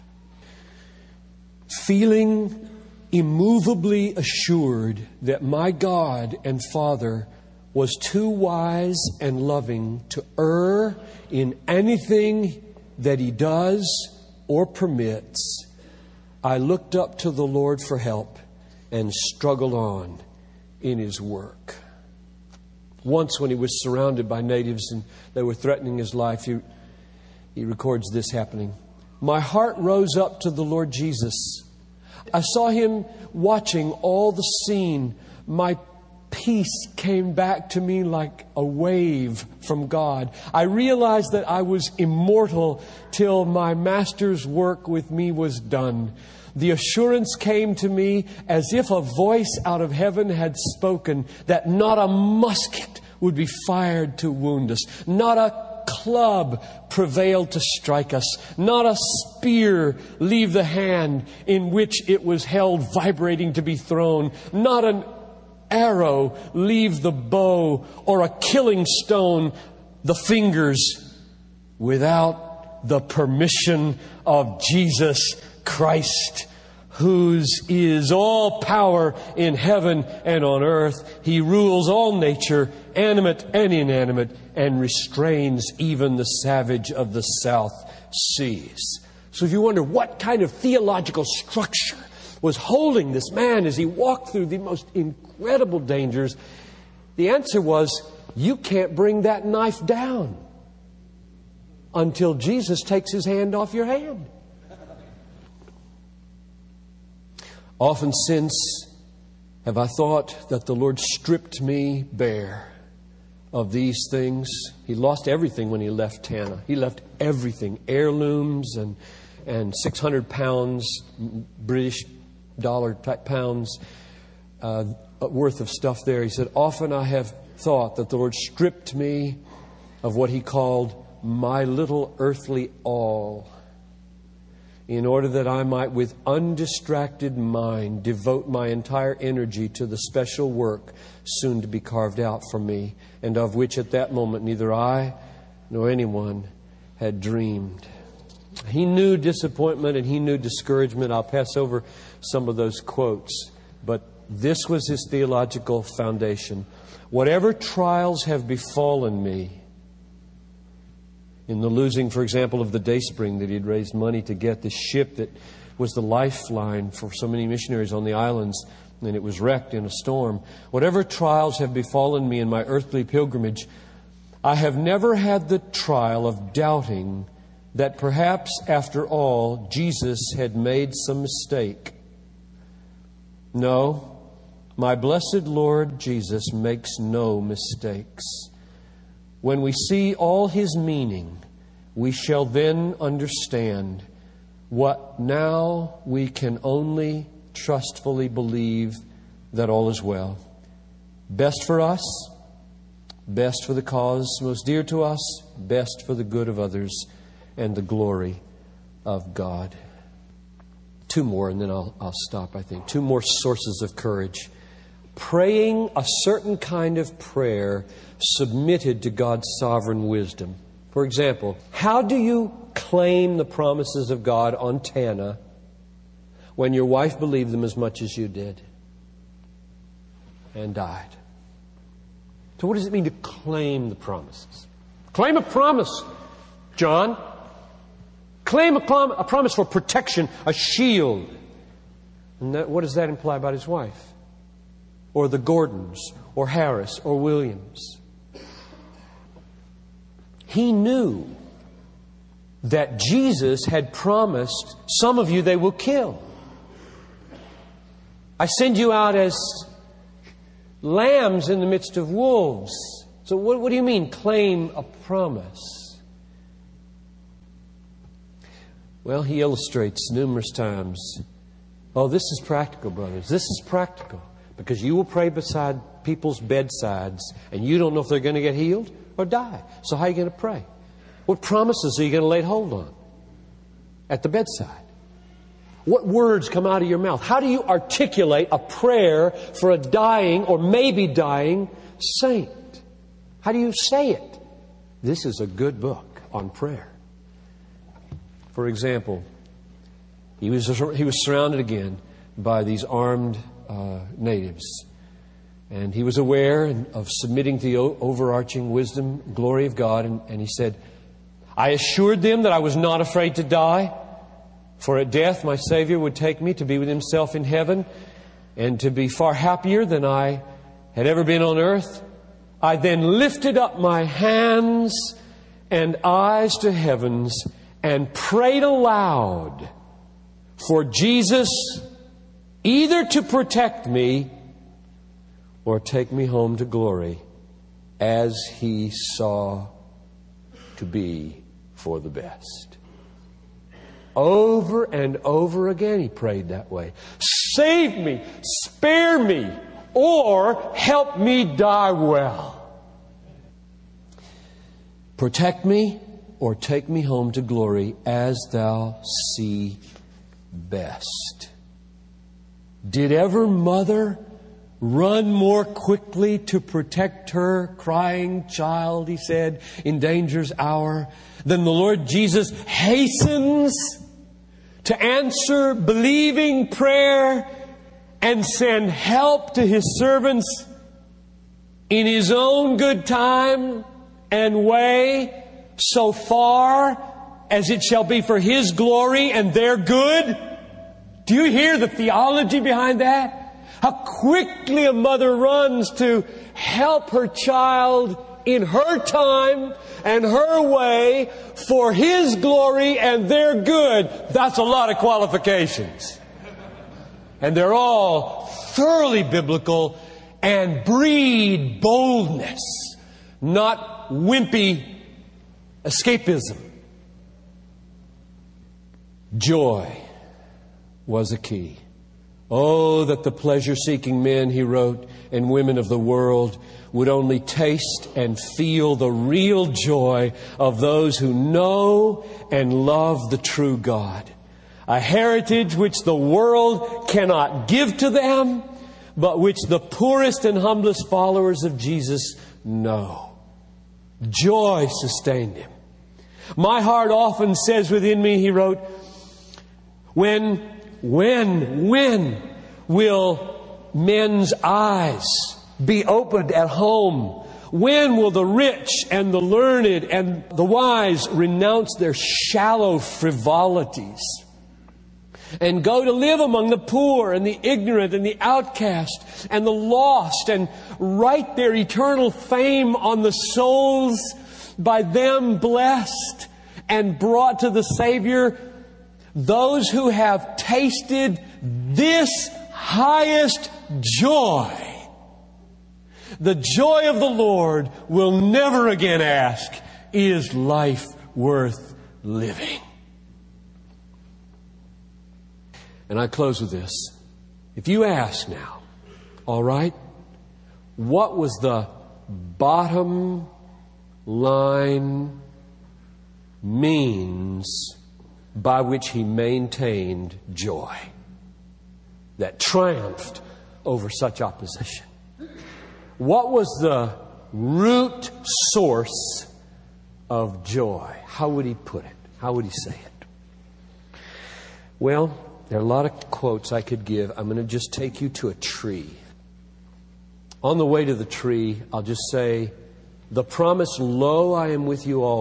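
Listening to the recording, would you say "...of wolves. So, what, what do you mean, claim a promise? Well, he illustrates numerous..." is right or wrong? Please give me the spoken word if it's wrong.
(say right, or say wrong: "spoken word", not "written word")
right.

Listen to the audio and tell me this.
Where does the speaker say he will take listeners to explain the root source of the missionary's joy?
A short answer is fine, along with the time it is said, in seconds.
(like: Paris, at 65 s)
a tree, at 528 s.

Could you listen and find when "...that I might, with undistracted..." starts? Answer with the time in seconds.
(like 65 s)
135 s.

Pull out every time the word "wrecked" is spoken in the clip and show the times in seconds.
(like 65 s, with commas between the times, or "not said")
169 s.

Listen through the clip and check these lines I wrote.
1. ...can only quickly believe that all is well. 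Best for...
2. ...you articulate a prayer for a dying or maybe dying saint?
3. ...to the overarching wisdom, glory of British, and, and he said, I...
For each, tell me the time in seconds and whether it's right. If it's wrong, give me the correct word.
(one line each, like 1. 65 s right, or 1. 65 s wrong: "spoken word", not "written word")
1. 196 s wrong: "trustfully", not "quickly"
2. 287 s right
3. 307 s wrong: "God", not "British".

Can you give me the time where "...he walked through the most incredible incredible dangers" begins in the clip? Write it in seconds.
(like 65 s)
93 s.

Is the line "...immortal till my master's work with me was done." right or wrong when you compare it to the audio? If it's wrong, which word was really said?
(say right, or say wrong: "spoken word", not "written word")
right.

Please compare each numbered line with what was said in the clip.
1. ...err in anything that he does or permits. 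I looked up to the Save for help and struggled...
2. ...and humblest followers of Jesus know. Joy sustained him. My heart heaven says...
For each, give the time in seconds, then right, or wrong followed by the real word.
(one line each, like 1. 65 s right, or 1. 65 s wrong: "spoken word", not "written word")
1. 10 s wrong: "Lord", not "Save"
2. 440 s wrong: "often", not "heaven".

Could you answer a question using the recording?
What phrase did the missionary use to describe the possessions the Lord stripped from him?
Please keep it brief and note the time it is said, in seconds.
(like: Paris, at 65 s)
my little earthly all, at 131 s.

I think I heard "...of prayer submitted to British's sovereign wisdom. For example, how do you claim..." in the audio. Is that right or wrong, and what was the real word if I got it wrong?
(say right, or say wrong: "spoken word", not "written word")
wrong: "God", not "British".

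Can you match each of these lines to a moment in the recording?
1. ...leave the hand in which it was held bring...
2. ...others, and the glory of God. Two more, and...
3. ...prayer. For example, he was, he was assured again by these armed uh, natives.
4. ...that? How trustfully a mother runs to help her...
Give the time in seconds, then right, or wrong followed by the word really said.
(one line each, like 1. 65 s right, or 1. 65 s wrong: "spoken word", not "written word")
1. 60 s wrong: "vibrating", not "bring"
2. 206 s right
3. 296 s wrong: "surrounded", not "assured"
4. 393 s wrong: "quickly", not "trustfully".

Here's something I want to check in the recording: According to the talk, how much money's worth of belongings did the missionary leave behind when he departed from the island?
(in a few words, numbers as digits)
600 pounds.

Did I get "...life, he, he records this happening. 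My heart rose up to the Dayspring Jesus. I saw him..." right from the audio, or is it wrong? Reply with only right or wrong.
wrong.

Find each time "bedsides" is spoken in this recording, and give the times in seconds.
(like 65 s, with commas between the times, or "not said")
276 s, 284 s.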